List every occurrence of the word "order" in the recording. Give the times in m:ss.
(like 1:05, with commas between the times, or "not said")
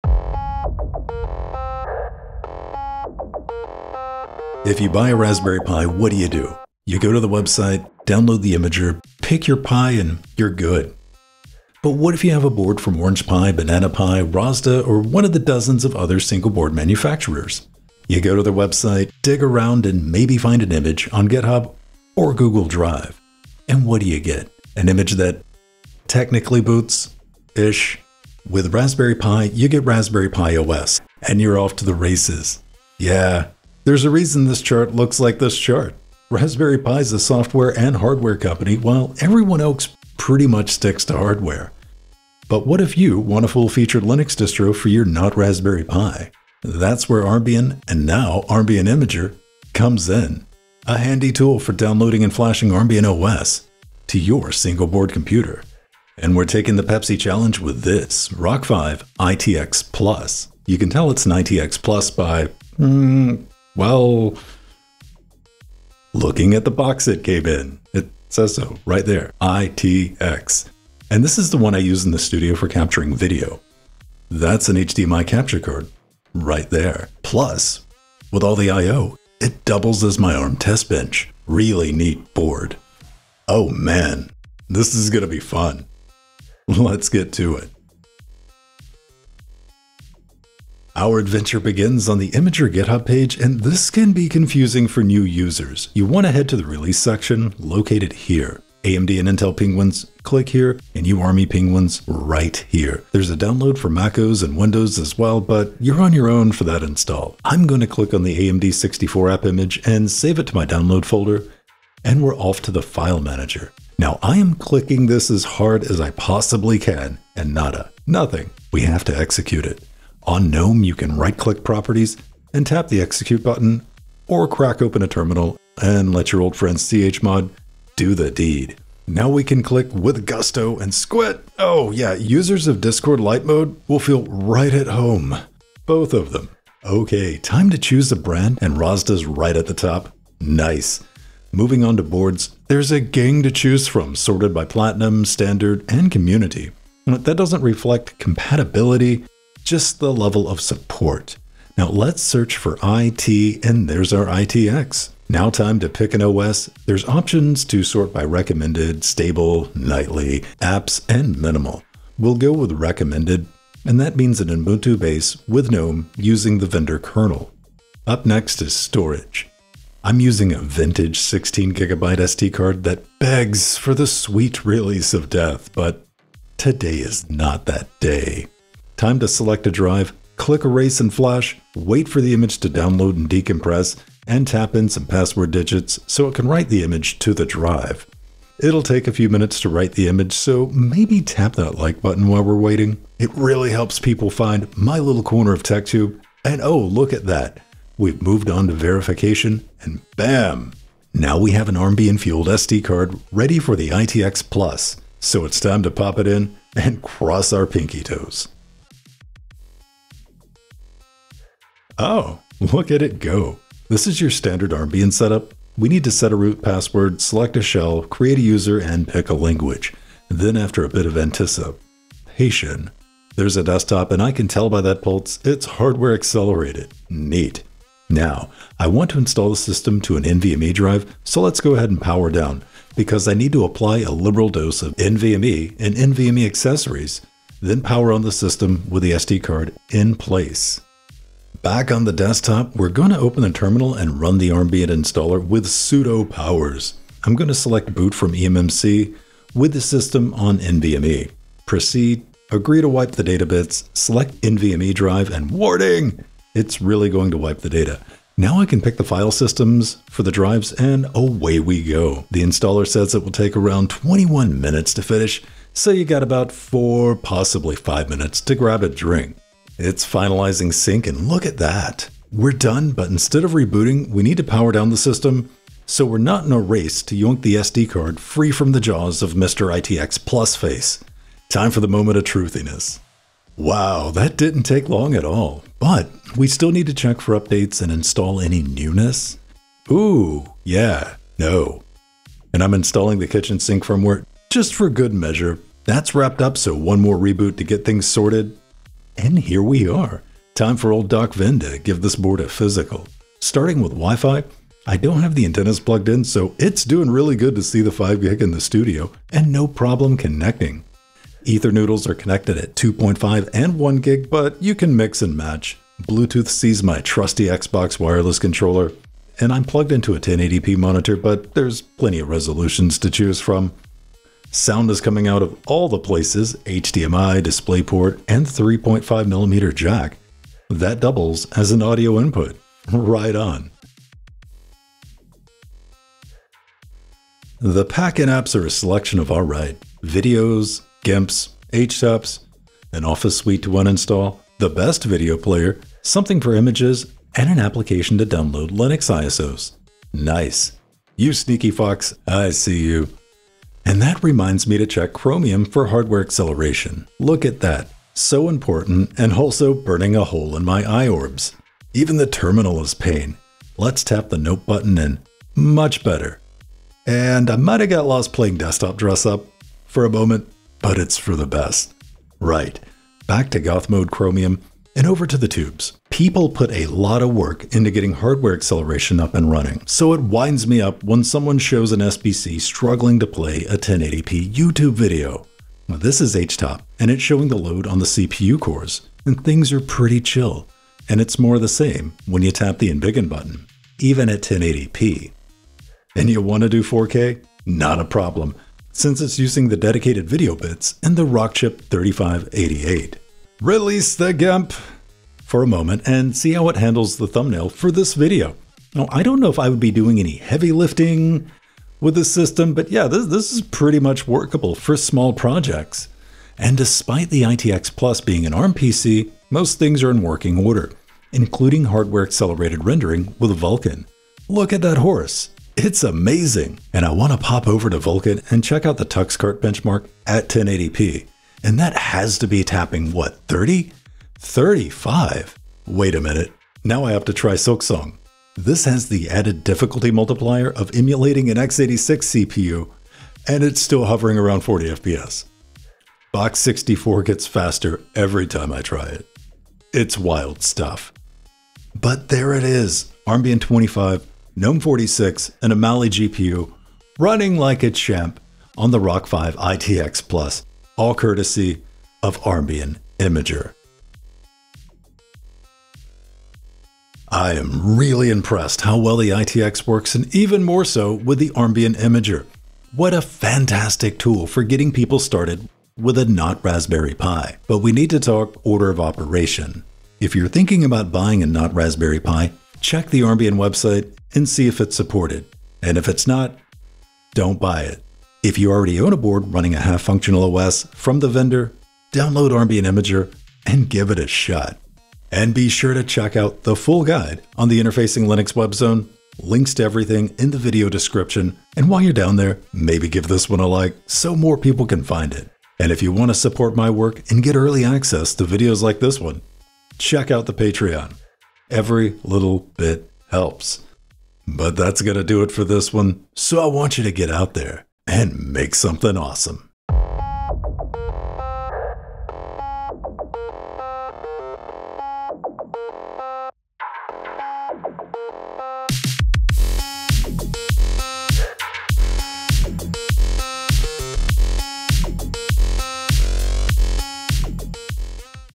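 7:00, 7:58.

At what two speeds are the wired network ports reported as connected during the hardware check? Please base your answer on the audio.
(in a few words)
2.5 and 1 gig.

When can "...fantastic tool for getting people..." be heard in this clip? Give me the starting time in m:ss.
7:53.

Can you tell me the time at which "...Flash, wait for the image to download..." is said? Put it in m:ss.
3:01.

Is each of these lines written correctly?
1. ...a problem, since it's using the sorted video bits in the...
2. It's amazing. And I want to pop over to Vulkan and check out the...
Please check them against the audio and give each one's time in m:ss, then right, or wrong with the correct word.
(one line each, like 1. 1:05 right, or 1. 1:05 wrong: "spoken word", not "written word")
1. 6:37 wrong: "dedicated", not "sorted"
2. 7:05 right.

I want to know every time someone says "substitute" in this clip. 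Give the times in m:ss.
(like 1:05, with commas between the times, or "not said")
not said.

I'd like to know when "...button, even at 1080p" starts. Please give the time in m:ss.
6:33.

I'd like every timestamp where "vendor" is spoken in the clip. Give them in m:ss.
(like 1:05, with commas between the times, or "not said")
2:46, 8:11.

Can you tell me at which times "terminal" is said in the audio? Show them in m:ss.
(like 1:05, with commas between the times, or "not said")
2:05, 4:03, 6:02.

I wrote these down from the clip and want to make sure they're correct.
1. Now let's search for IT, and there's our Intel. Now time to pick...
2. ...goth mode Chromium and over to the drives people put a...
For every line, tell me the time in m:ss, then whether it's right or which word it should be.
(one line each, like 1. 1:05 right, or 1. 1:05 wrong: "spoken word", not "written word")
1. 2:31 wrong: "ITX", not "Intel"
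2. 6:13 wrong: "tubes", not "drives".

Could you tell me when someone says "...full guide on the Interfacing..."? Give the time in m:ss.
8:16.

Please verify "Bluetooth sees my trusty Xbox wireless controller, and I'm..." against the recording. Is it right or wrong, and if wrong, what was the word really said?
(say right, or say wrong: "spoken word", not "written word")
right.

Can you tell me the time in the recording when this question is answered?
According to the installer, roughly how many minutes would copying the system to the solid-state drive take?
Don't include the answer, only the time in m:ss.
4:23.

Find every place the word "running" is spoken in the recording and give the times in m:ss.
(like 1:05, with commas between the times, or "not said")
6:19, 7:37, 8:09.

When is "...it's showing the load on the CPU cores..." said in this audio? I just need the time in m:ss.
6:27.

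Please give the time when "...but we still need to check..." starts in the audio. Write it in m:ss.
4:45.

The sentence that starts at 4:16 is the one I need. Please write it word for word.
It's really going to wipe the data.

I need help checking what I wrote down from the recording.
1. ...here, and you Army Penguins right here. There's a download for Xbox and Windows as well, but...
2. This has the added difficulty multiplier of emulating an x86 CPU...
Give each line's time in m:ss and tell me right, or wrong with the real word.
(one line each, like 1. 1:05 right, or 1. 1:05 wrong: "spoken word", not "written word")
1. 1:40 wrong: "MacOS", not "Xbox"
2. 7:18 right.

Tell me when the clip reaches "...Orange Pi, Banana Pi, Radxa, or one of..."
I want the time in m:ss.
0:13.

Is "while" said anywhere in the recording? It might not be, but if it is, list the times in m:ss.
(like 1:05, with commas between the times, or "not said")
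0:38, 3:12, 8:21.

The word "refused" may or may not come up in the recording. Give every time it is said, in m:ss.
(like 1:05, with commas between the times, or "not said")
not said.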